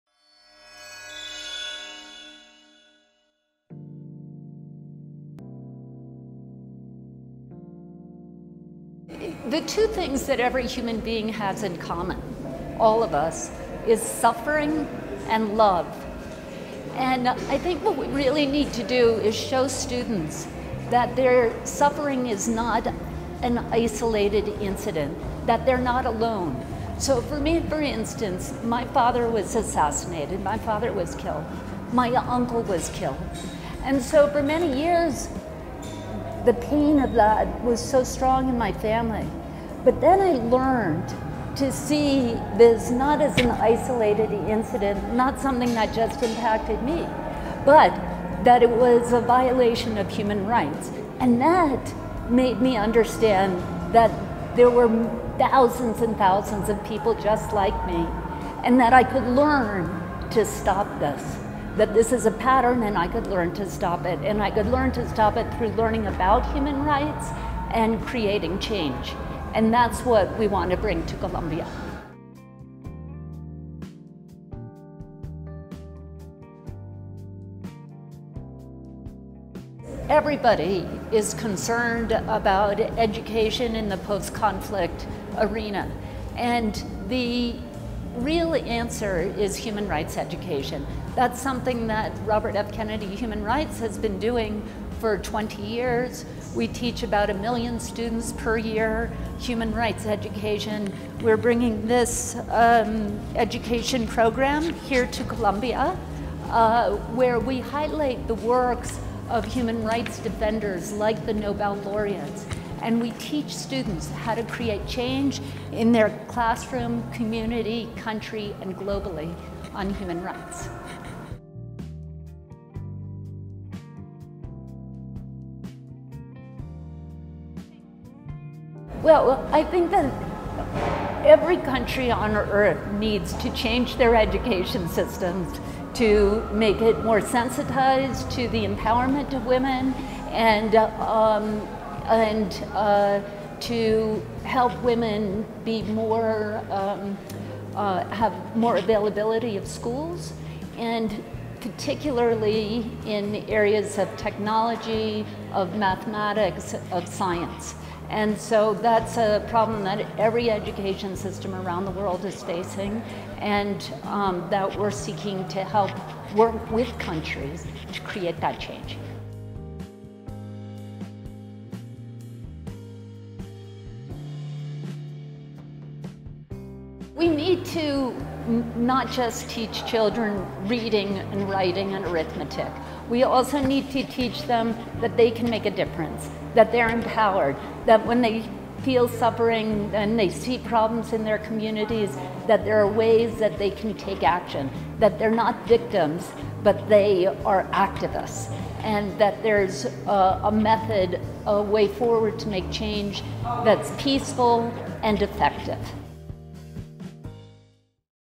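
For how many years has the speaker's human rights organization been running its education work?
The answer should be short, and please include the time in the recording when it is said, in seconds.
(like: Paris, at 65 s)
20 years, at 95 s.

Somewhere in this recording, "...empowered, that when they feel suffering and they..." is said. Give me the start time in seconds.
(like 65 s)
186 s.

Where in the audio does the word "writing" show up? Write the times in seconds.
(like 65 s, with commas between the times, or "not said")
181 s.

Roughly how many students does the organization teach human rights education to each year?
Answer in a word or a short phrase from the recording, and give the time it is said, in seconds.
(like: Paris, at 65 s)
about a million, at 97 s.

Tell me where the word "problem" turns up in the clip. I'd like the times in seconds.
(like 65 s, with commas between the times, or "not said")
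159 s, 190 s.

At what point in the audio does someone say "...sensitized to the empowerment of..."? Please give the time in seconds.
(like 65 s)
137 s.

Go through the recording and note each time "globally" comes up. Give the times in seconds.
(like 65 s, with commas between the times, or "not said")
118 s.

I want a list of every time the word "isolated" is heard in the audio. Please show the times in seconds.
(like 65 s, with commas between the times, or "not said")
23 s, 43 s.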